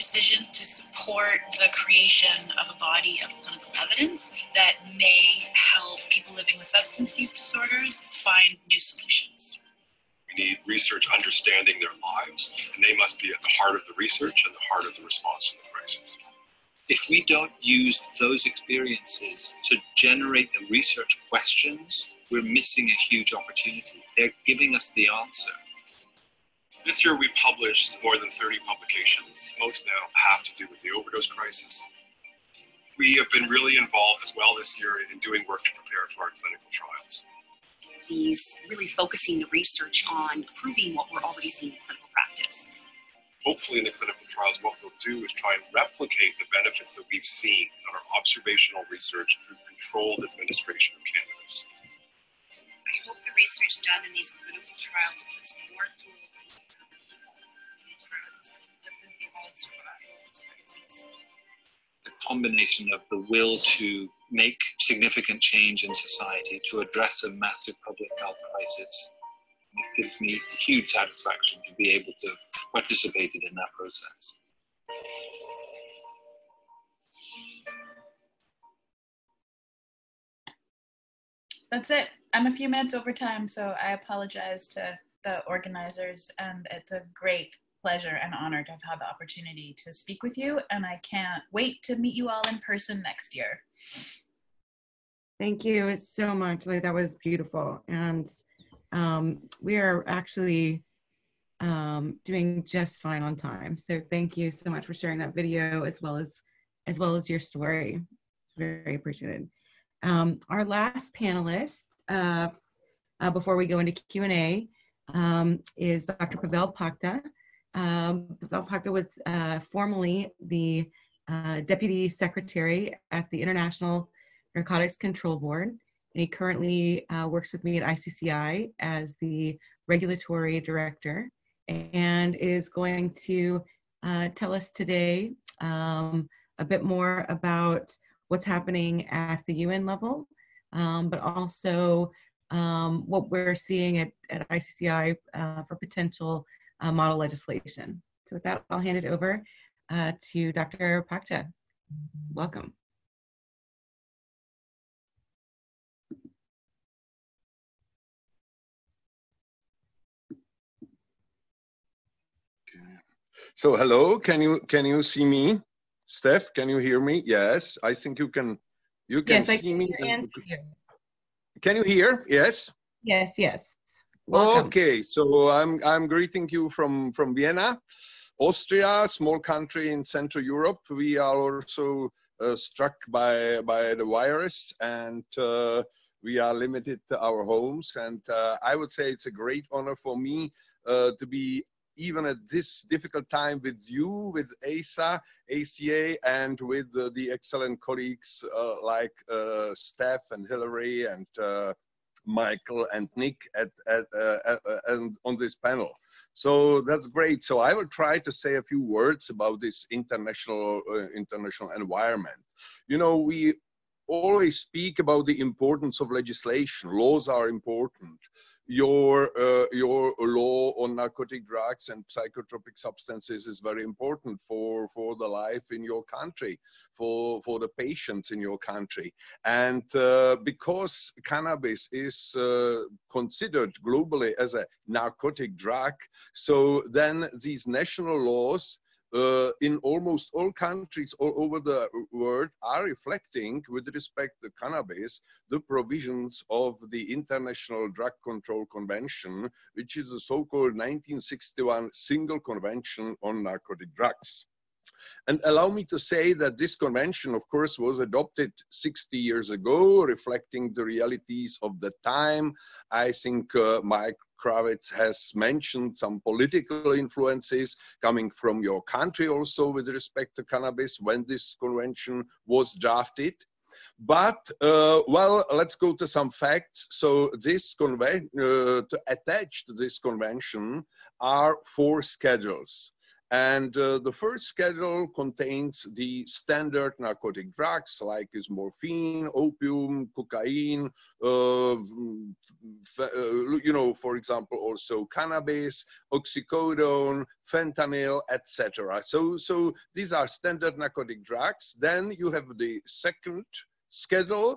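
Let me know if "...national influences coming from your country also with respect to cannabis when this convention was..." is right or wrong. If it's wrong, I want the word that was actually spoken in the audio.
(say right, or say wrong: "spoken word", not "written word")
wrong: "political", not "national".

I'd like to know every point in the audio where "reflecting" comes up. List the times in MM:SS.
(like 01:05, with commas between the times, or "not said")
04:02, 04:20.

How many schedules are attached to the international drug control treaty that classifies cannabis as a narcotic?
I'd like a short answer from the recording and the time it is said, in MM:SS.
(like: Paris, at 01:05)
4, at 04:41.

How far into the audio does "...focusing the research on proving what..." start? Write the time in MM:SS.
00:38.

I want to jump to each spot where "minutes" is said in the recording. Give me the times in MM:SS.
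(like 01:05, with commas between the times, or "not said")
01:22.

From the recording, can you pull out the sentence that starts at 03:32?
You know, we always speak about the importance of legislation.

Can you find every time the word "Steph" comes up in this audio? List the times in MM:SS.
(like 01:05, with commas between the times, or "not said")
02:46, 03:19.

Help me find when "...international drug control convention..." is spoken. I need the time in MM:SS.
04:07.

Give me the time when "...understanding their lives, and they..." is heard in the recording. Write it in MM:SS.
00:11.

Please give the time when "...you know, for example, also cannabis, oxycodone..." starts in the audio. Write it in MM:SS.
04:53.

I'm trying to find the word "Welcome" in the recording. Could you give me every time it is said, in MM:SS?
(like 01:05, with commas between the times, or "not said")
02:32, 02:54.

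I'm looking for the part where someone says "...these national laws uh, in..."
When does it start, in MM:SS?
03:57.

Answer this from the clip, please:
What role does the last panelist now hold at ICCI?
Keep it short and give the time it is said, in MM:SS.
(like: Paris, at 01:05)
Regulatory Director, at 02:09.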